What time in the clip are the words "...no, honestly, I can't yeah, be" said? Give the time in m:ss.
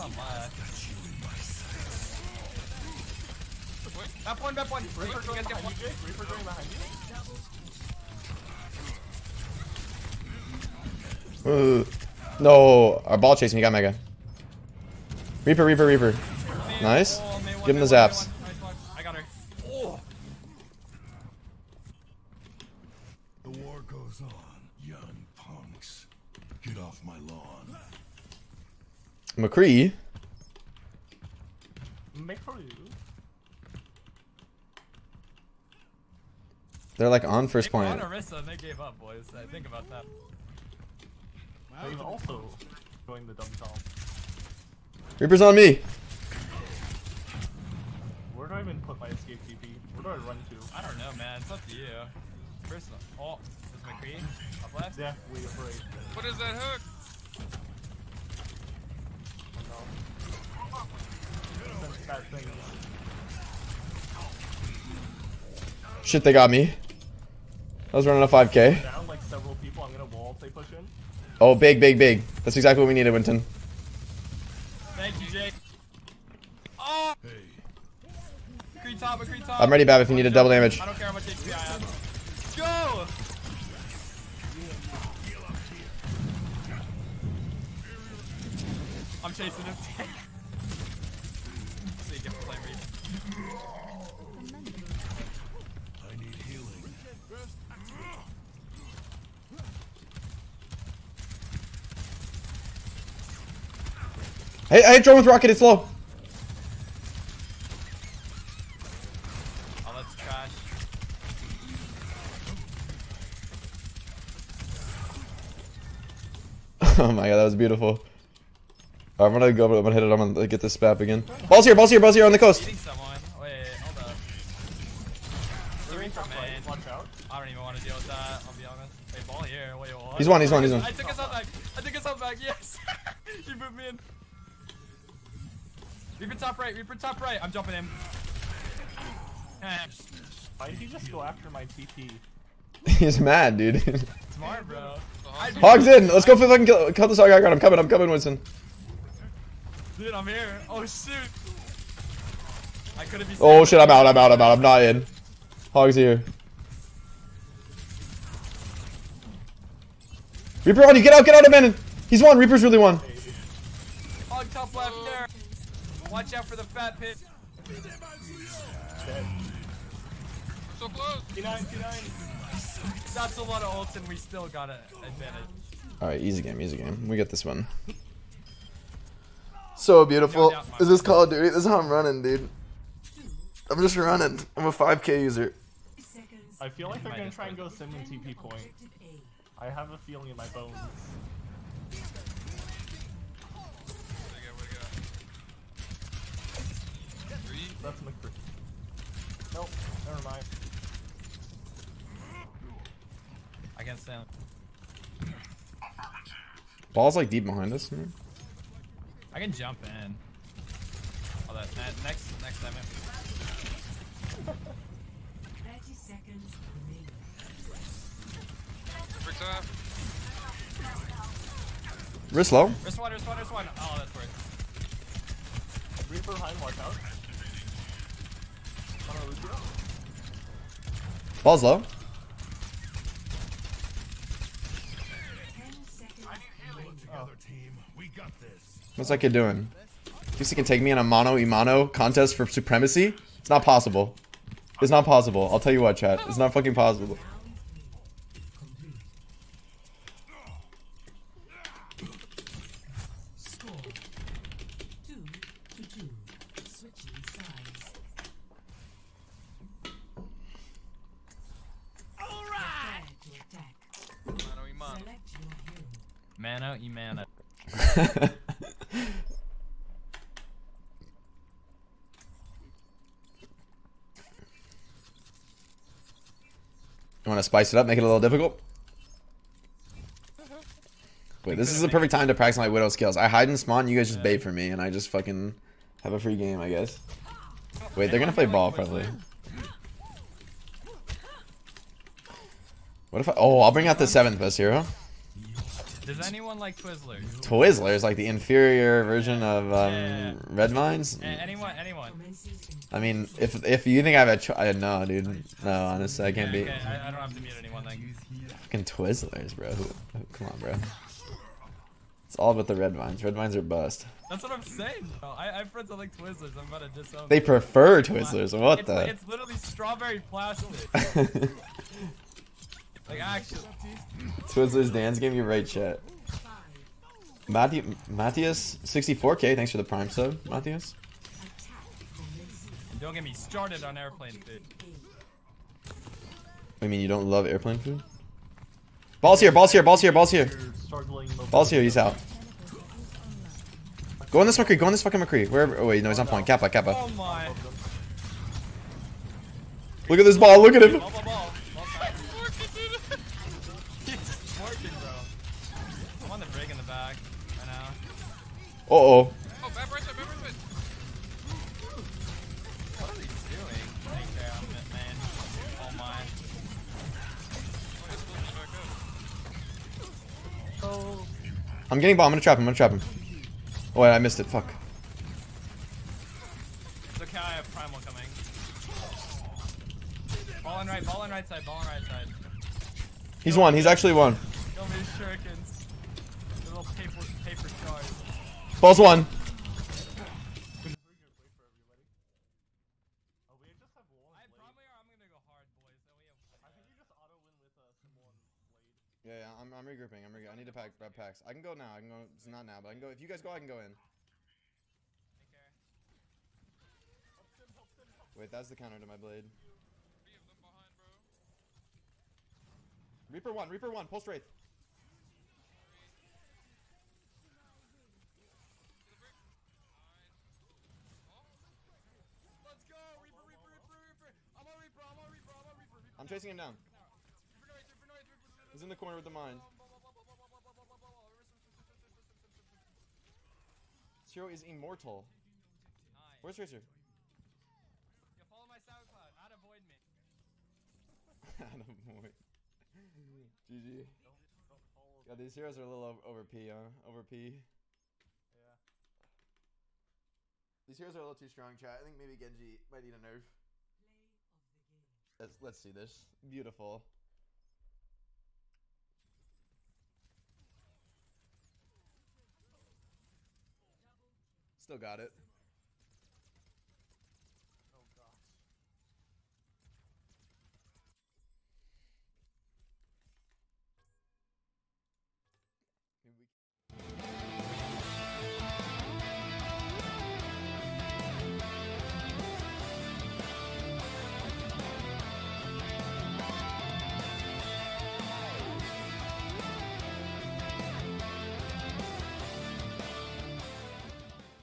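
5:05.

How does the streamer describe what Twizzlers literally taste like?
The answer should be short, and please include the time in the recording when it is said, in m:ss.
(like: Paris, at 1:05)
strawberry plastic, at 5:19.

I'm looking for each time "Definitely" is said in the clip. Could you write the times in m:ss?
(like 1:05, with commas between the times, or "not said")
0:54.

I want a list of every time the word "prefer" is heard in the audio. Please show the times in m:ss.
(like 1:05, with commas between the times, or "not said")
5:17.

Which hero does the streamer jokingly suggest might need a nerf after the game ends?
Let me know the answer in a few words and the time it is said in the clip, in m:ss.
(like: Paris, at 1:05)
Genji, at 7:32.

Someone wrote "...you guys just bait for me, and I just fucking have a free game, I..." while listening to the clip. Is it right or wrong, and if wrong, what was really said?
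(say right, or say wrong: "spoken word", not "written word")
right.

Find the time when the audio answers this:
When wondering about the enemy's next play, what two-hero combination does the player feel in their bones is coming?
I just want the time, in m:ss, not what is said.
3:07.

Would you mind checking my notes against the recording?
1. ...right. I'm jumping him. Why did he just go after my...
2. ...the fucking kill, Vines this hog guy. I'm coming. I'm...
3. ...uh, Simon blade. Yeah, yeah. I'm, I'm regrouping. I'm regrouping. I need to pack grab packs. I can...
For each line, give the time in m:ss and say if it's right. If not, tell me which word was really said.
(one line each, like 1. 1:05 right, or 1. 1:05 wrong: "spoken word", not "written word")
1. 2:17 right
2. 2:26 wrong: "Cut", not "Vines"
3. 6:37 right.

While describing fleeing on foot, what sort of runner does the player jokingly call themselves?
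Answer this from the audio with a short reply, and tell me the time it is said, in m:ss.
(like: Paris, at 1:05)
5k user, at 3:04.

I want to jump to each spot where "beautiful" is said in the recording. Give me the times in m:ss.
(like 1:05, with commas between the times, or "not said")
1:57, 3:00, 7:36.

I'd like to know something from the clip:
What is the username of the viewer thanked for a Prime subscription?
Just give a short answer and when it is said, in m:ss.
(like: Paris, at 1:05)
Matthias 64k, at 5:27.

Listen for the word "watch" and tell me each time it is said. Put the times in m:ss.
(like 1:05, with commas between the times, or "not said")
2:46, 3:46.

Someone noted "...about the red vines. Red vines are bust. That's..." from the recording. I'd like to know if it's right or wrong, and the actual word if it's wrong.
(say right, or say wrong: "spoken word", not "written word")
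right.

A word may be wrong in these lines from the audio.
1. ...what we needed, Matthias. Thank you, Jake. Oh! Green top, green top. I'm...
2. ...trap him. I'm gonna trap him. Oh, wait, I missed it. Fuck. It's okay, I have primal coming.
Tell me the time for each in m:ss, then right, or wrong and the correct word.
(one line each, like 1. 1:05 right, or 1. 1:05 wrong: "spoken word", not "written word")
1. 1:12 wrong: "Winston", not "Matthias"
2. 6:12 right.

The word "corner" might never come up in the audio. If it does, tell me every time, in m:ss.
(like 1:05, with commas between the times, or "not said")
7:08.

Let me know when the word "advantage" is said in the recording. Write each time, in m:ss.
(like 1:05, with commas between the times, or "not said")
2:54.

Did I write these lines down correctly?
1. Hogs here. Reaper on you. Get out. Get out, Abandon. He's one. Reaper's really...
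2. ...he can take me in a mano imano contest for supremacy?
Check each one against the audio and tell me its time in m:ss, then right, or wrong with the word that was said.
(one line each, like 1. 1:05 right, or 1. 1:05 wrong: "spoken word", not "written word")
1. 2:35 right
2. 4:00 right.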